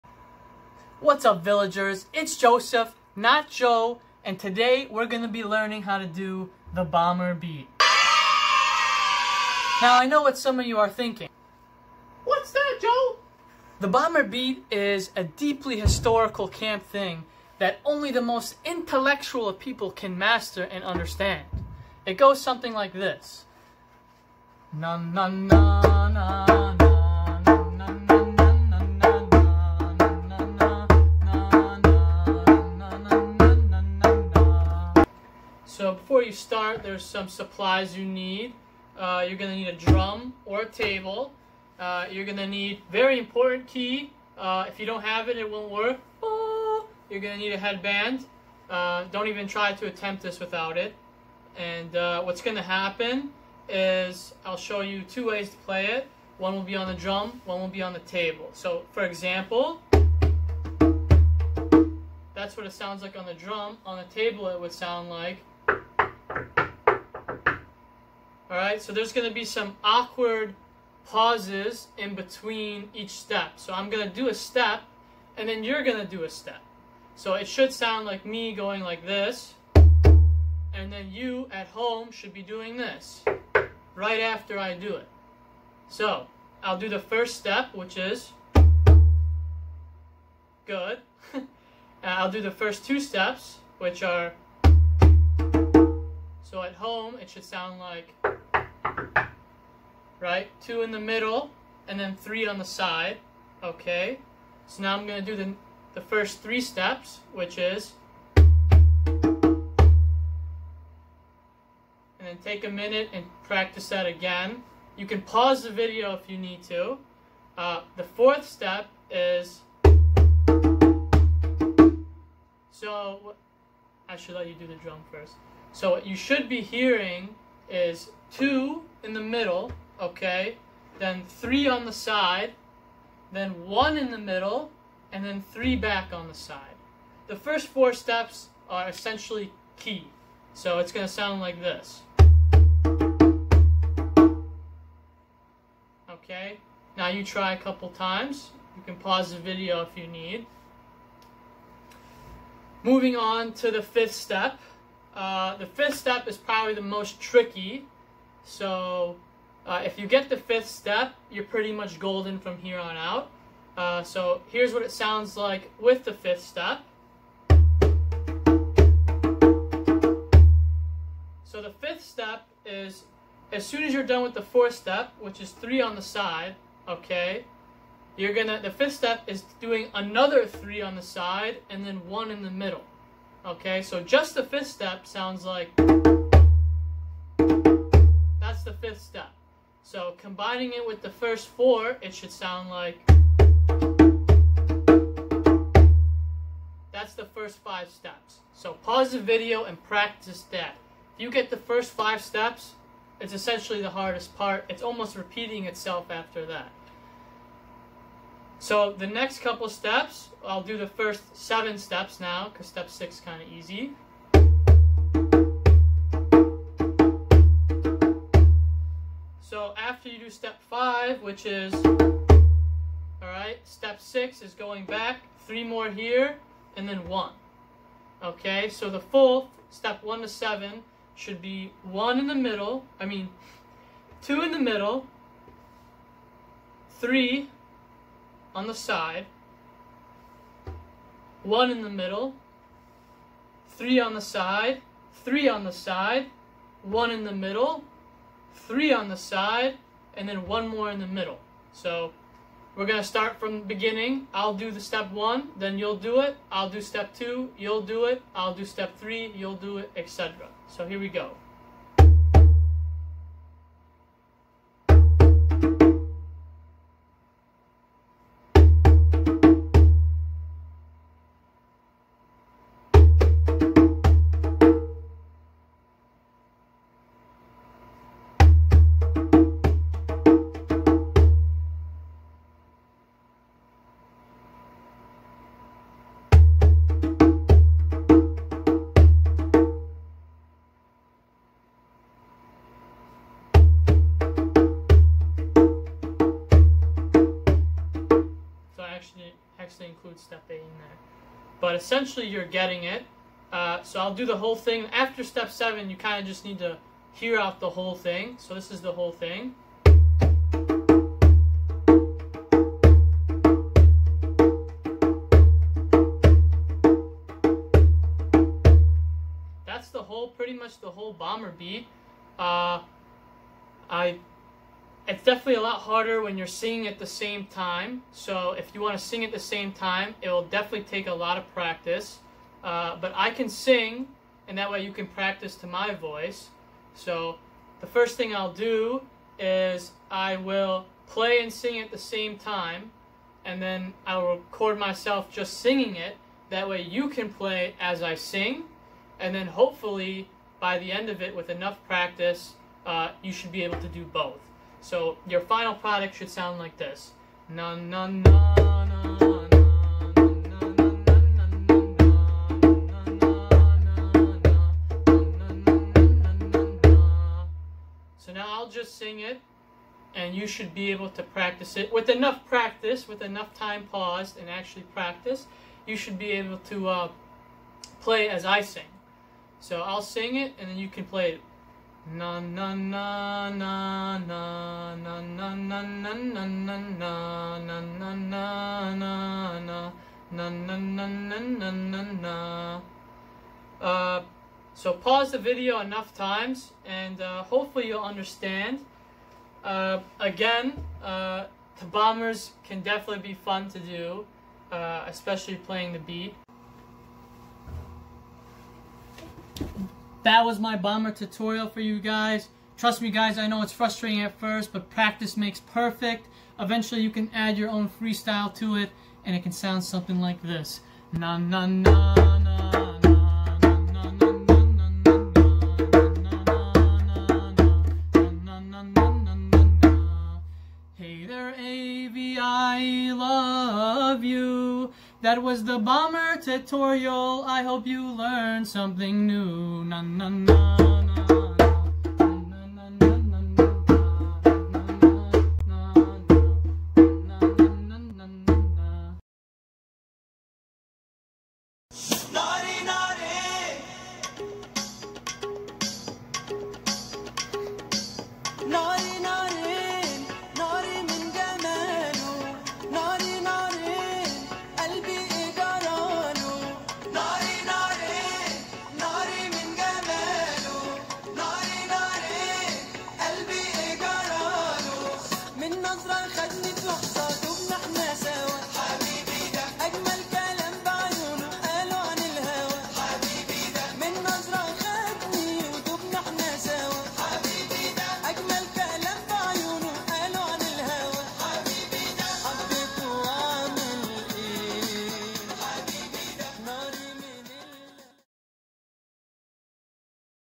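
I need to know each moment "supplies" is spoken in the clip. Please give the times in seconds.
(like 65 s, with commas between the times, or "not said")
37 s.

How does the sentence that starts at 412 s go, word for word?
Trust me guys, I know it's frustrating at first, but practice makes perfect.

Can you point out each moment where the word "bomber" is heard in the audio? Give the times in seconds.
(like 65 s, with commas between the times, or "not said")
6 s, 13 s, 321 s, 410 s, 435 s.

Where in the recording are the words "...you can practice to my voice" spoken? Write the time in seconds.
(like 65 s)
334 s.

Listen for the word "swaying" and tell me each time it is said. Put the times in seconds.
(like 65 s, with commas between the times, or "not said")
not said.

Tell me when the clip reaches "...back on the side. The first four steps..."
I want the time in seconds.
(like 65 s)
135 s.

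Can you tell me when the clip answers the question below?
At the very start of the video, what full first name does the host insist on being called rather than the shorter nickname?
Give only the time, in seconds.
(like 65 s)
2 s.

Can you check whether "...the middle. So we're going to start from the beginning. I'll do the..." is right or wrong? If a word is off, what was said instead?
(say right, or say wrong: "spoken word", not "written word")
right.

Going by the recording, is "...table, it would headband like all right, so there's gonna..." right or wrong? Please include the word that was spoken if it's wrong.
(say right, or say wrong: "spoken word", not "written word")
wrong: "sound", not "headband".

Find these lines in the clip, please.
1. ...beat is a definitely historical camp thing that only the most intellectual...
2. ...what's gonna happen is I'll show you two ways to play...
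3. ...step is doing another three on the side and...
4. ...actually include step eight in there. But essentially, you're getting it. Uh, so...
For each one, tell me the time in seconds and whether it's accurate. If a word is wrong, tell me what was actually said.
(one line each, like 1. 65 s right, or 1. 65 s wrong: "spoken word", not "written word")
1. 14 s wrong: "deeply", not "definitely"
2. 52 s right
3. 178 s right
4. 299 s right.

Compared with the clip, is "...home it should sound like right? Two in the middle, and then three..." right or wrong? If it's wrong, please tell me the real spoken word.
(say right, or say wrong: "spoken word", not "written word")
right.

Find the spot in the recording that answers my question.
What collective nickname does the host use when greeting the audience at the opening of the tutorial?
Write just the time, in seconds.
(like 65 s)
1 s.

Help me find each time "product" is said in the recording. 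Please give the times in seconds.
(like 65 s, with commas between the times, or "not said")
355 s.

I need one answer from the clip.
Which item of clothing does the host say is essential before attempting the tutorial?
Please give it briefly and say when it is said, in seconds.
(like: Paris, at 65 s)
headband, at 47 s.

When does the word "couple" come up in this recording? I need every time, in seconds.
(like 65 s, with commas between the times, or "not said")
147 s, 209 s.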